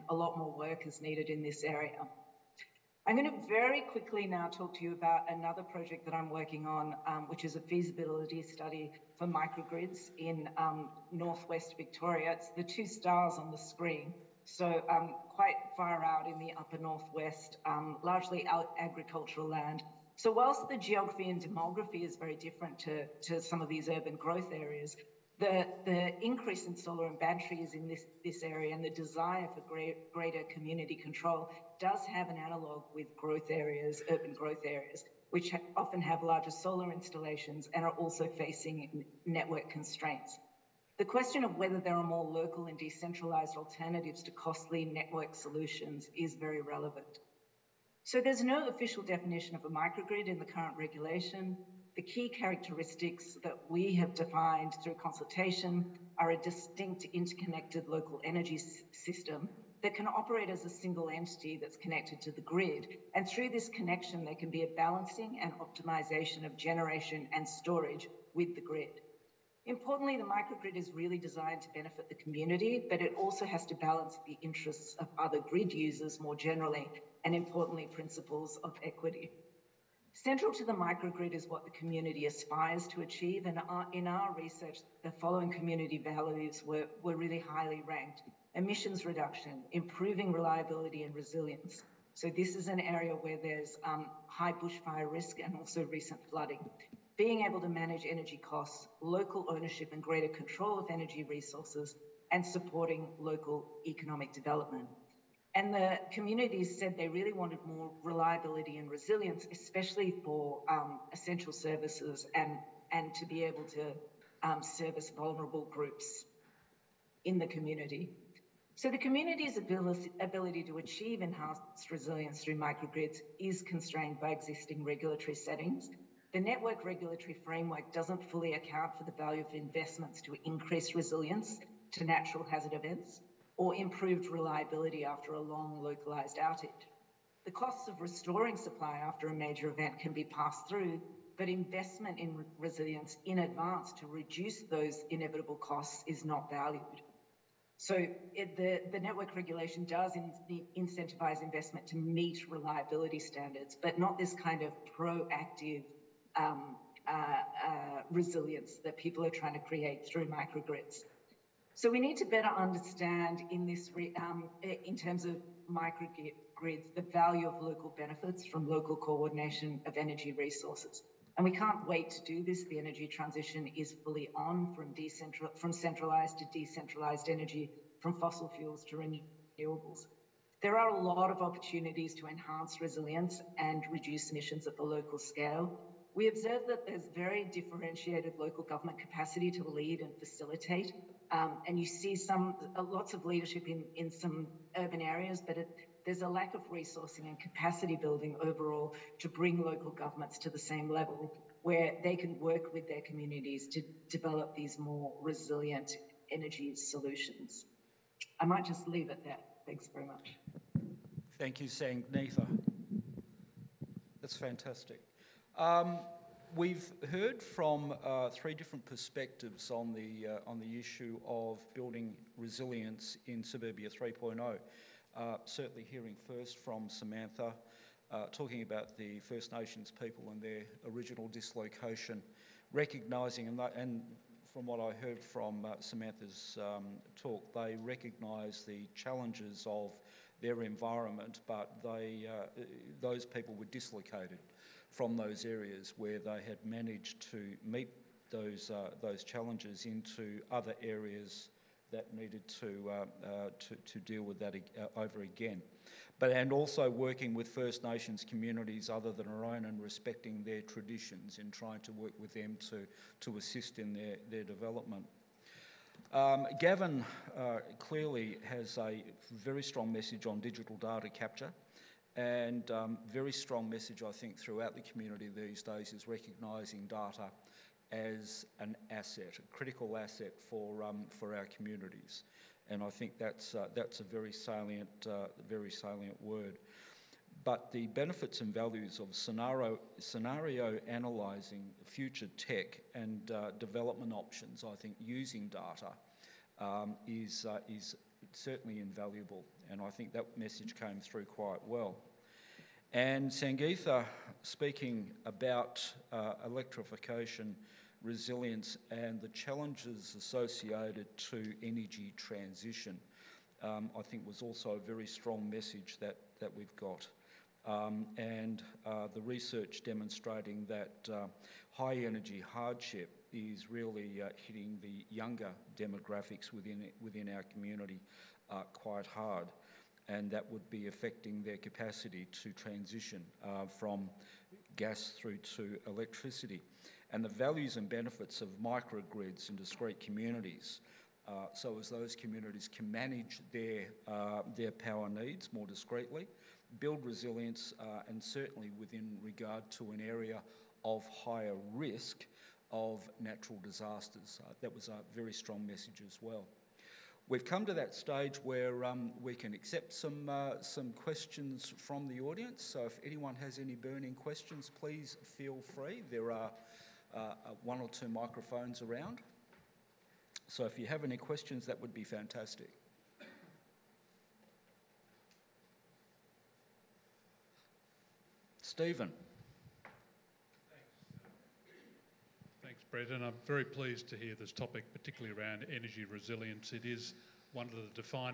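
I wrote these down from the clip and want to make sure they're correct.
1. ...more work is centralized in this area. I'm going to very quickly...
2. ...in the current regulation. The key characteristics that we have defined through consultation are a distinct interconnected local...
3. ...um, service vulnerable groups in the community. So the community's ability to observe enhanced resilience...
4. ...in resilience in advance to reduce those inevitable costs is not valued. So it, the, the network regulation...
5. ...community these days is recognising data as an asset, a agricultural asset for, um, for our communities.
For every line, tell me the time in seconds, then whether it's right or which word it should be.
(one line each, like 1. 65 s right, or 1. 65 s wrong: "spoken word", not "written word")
1. 0 s wrong: "needed", not "centralized"
2. 50 s right
3. 114 s wrong: "achieve", not "observe"
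4. 142 s right
5. 274 s wrong: "critical", not "agricultural".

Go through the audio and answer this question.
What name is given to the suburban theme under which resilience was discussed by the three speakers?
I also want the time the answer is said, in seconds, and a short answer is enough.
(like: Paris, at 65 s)
Suburbia 3.0, at 223 s.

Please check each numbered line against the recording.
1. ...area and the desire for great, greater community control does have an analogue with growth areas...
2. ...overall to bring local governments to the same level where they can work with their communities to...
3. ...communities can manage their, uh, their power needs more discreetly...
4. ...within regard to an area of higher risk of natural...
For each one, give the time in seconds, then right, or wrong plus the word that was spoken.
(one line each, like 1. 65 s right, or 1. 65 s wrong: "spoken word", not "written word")
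1. 28 s right
2. 198 s right
3. 342 s right
4. 348 s right.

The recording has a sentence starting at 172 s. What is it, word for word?
The energy transition is fully on from, decentral, from centralized to decentralized energy, from fossil fuels to renewables.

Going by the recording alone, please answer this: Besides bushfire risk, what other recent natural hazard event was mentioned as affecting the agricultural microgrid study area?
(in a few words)
Flooding.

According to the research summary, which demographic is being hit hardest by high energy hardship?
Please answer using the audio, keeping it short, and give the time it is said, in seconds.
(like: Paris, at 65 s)
Younger demographics, at 325 s.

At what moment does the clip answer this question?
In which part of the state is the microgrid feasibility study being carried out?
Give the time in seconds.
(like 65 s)
11 s.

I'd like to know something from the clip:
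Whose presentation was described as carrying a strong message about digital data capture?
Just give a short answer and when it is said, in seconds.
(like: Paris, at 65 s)
Gavin, at 266 s.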